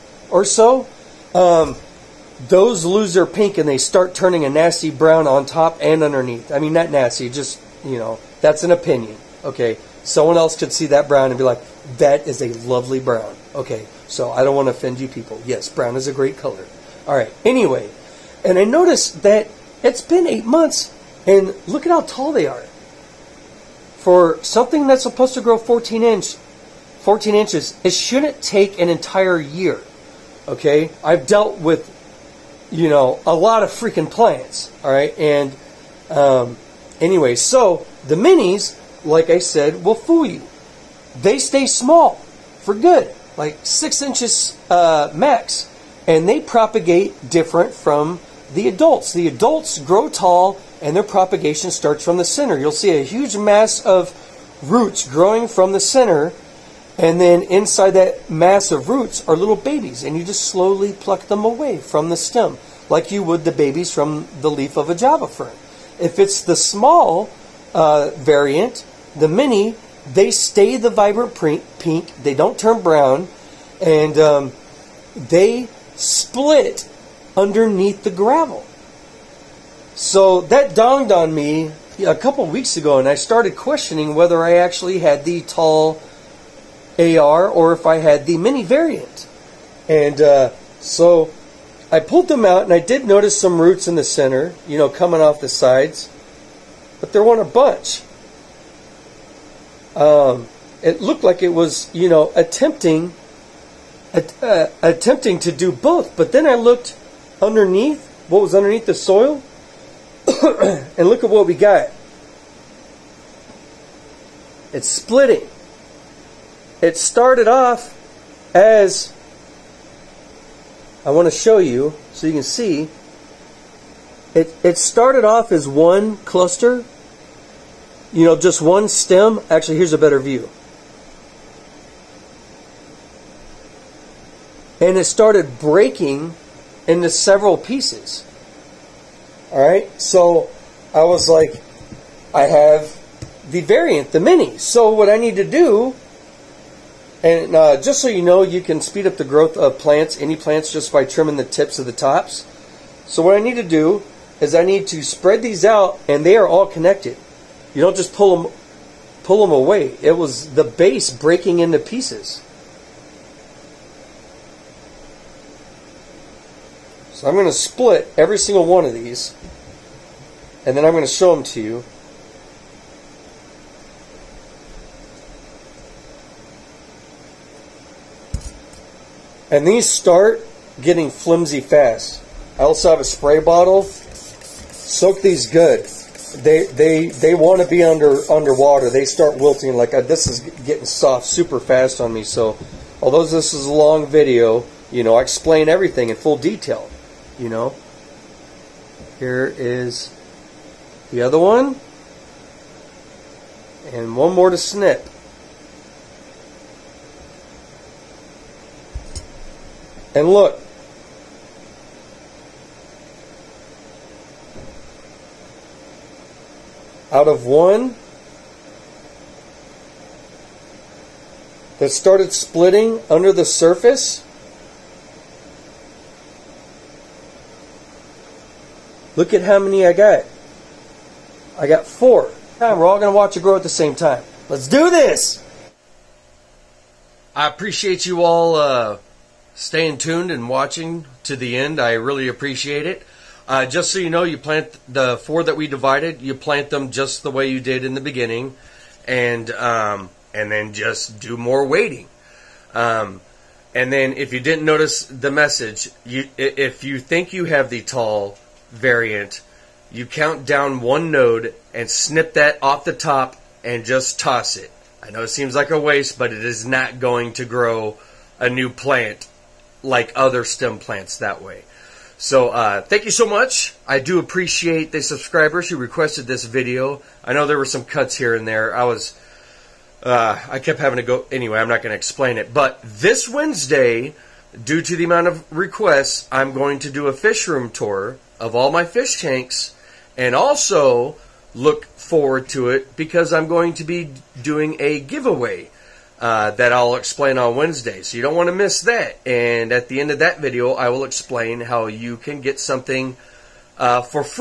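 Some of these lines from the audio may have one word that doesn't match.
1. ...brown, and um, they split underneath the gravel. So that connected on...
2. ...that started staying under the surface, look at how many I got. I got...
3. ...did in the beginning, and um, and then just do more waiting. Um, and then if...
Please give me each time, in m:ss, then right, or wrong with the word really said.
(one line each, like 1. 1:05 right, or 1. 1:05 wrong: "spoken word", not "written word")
1. 1:12 wrong: "dawned", not "connected"
2. 3:41 wrong: "splitting", not "staying"
3. 4:07 right.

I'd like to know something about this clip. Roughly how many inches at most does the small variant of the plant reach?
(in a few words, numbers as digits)
6 inches.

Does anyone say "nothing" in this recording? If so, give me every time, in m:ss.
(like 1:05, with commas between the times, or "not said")
not said.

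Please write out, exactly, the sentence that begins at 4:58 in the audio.
So you don't want to miss that.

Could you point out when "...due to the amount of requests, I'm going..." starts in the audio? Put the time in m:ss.
4:44.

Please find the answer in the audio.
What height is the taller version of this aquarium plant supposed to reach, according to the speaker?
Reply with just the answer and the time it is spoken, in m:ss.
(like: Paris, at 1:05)
14 inches, at 0:27.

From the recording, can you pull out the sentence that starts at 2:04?
It, it started off as one cluster, you know, just one stem.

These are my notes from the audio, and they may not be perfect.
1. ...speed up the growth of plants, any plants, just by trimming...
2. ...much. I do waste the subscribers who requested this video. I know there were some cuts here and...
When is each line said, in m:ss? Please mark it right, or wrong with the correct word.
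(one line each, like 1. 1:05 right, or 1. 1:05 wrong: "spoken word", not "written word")
1. 2:28 right
2. 4:33 wrong: "appreciate", not "waste".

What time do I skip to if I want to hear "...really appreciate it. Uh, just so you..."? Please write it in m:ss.
4:01.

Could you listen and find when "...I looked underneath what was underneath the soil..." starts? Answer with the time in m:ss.
1:46.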